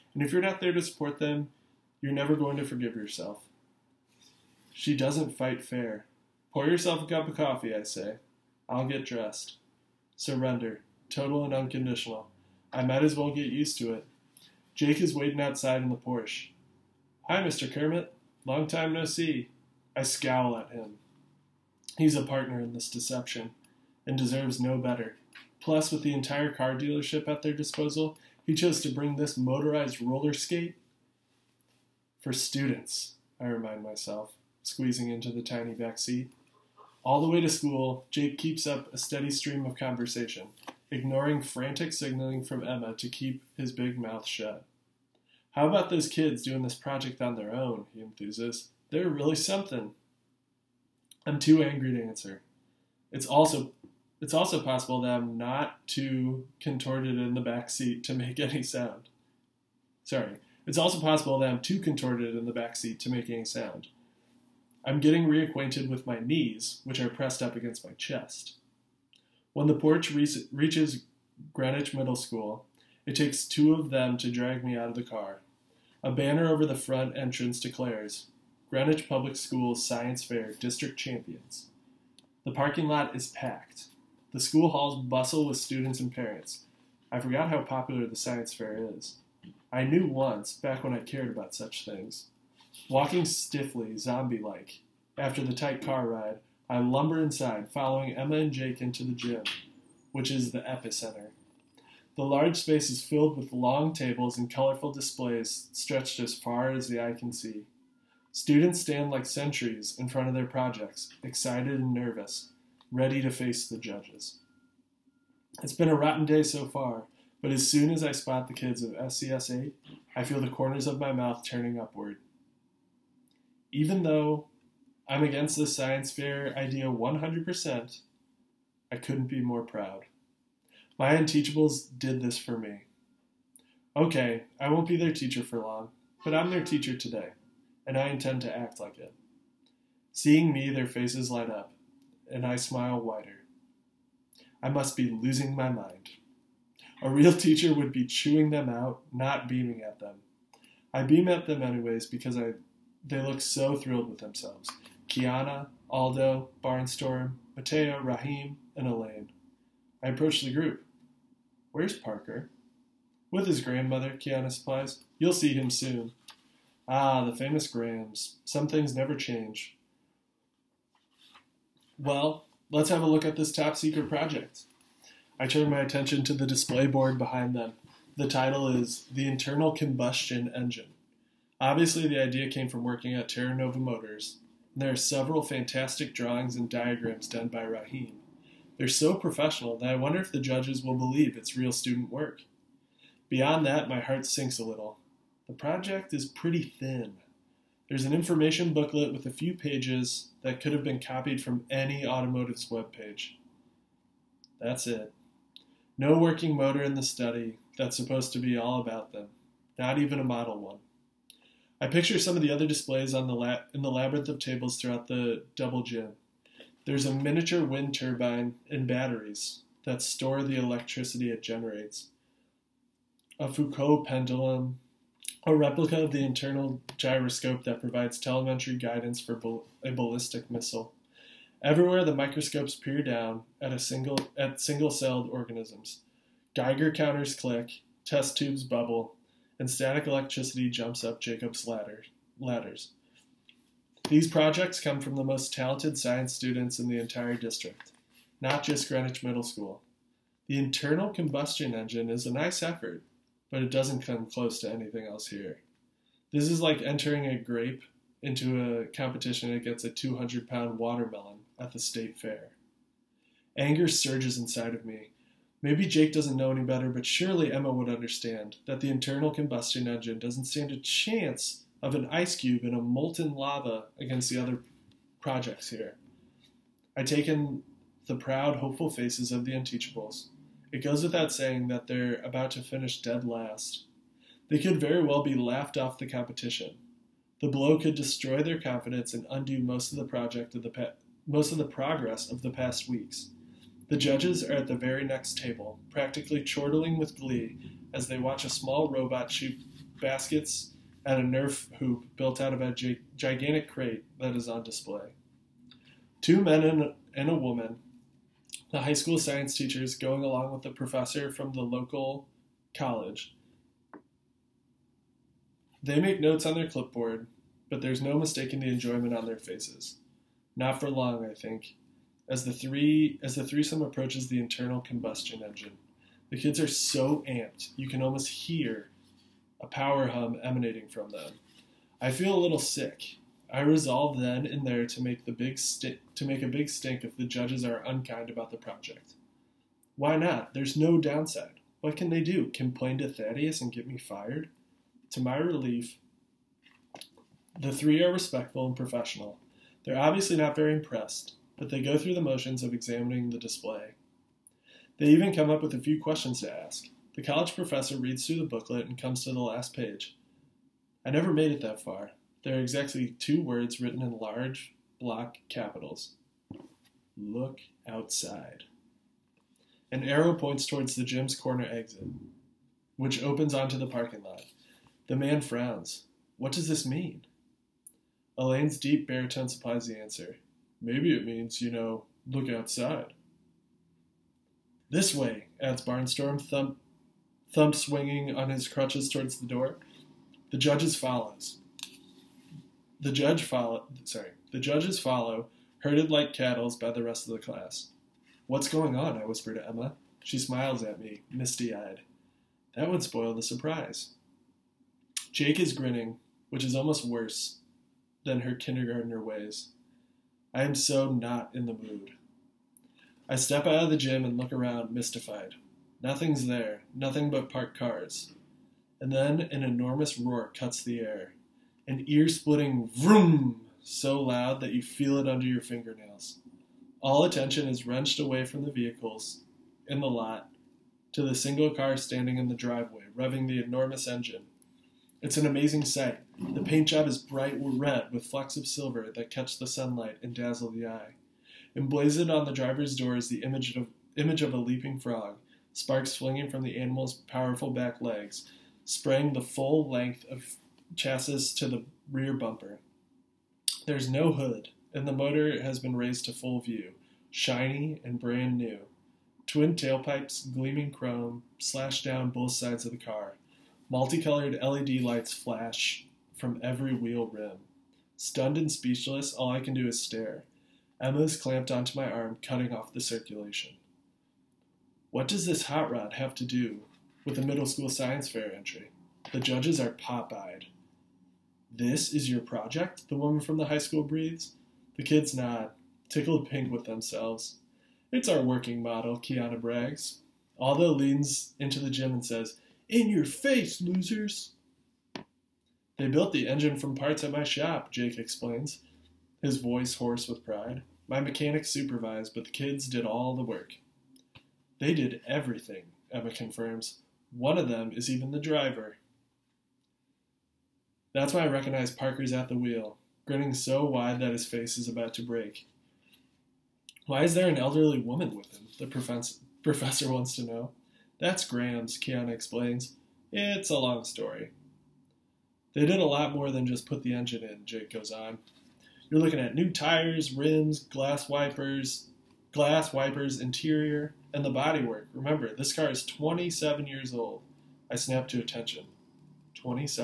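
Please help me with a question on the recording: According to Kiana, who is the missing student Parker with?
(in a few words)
His grandmother.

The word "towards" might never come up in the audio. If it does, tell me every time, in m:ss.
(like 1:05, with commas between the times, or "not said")
6:10, 6:29.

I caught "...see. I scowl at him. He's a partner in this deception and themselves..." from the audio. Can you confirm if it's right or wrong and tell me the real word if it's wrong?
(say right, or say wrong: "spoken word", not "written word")
wrong: "deserves", not "themselves".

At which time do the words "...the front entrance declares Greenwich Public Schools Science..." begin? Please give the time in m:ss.
1:16.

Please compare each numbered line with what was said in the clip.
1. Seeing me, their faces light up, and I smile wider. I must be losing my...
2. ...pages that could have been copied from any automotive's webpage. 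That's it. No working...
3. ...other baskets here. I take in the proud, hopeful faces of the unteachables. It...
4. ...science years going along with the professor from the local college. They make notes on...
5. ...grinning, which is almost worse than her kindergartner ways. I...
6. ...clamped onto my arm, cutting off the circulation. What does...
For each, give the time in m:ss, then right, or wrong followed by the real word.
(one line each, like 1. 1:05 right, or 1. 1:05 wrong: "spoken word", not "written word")
1. 2:20 right
2. 3:19 right
3. 4:34 wrong: "projects", not "baskets"
4. 5:09 wrong: "teachers", not "years"
5. 6:45 right
6. 7:51 right.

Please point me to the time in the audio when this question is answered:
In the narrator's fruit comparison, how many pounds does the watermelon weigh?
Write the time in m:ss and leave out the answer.
4:19.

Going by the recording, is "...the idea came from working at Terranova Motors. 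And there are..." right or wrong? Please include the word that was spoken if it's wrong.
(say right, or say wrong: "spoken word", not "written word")
right.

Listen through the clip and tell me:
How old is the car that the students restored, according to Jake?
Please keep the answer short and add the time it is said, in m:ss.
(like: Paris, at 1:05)
27 years, at 8:56.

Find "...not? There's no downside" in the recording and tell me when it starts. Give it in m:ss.
5:40.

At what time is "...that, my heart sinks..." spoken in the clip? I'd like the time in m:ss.
3:13.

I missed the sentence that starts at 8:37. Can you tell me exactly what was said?
Why is there an elderly woman with him?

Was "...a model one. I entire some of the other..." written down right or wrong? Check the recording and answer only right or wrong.
wrong.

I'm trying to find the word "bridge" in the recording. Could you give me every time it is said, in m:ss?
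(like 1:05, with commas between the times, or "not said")
not said.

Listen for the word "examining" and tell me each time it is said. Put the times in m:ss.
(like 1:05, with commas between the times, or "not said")
5:52.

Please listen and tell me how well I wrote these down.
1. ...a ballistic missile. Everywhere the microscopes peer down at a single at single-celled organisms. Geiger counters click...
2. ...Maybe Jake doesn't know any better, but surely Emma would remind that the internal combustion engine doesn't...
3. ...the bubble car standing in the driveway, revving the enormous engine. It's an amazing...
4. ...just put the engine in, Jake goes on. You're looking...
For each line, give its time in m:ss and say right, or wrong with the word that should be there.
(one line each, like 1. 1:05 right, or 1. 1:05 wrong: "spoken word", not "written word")
1. 3:49 right
2. 4:25 wrong: "understand", not "remind"
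3. 7:11 wrong: "single", not "bubble"
4. 8:46 right.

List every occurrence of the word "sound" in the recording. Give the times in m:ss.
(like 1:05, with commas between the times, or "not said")
0:58, 1:03.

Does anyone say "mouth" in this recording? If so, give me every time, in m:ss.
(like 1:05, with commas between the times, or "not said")
0:43, 2:01.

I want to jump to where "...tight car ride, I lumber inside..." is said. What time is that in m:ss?
1:35.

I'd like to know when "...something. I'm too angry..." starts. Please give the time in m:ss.
0:49.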